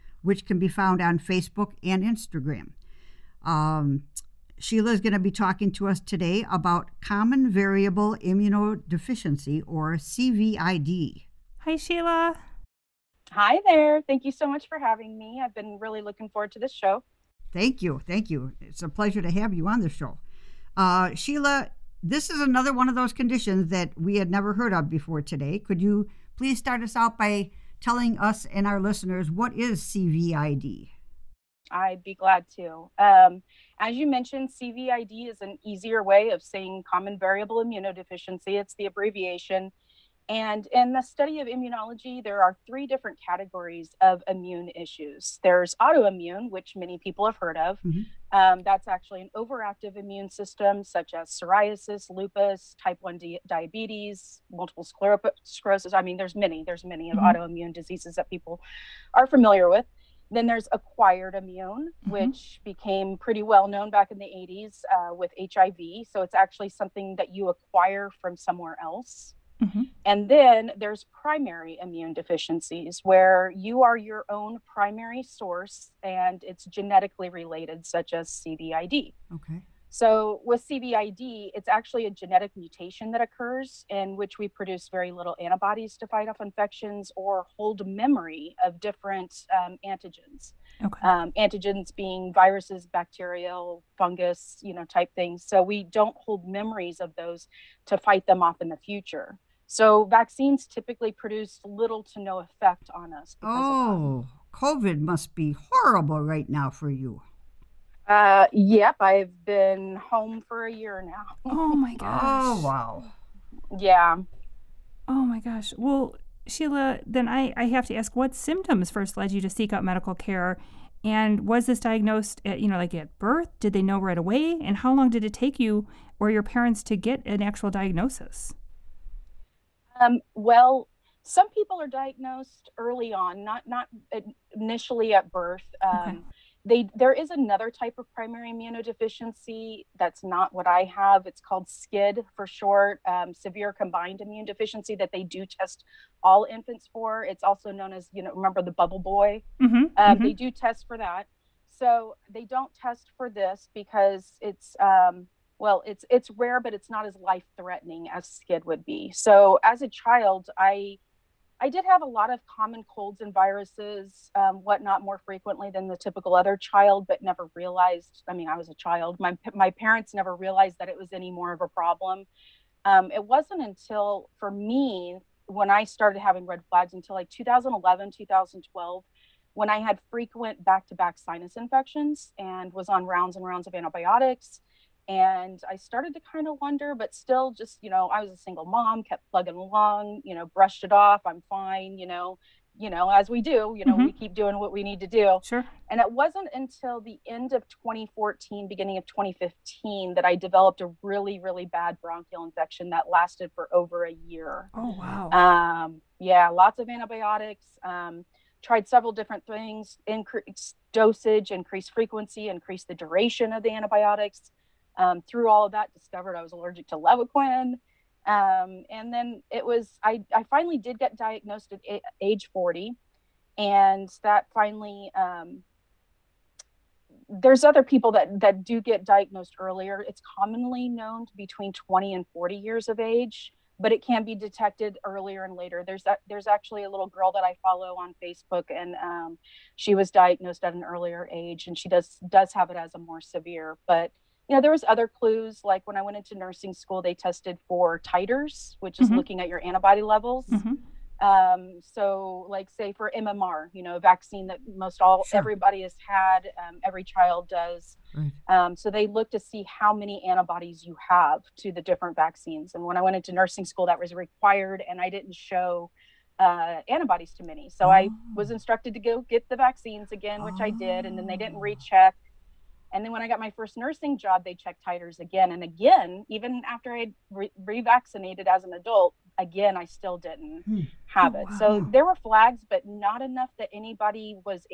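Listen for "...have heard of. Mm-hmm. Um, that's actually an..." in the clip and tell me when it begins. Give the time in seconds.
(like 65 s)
47 s.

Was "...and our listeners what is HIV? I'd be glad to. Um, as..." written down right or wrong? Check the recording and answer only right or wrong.
wrong.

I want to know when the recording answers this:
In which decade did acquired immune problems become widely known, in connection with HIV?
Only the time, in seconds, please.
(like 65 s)
64 s.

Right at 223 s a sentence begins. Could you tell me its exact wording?
And that finally, um, there's other people that, that do get diagnosed earlier.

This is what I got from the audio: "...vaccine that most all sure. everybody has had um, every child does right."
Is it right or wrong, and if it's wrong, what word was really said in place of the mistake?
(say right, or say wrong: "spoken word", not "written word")
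right.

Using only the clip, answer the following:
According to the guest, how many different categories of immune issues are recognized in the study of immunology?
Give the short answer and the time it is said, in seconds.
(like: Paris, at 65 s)
3, at 42 s.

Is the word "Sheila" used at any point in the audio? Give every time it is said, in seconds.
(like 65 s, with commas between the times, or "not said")
4 s, 11 s, 21 s, 116 s.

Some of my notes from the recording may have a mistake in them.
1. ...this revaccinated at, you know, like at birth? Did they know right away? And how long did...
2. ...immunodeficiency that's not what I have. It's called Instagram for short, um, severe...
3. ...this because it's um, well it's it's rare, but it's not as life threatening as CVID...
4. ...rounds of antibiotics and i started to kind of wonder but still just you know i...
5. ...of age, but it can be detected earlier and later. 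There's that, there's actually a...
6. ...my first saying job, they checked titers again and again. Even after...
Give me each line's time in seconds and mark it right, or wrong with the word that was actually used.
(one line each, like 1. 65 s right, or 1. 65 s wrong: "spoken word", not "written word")
1. 121 s wrong: "diagnosed", not "revaccinated"
2. 138 s wrong: "SCID", not "Instagram"
3. 153 s wrong: "SCID", not "CVID"
4. 183 s right
5. 232 s right
6. 273 s wrong: "nursing", not "saying".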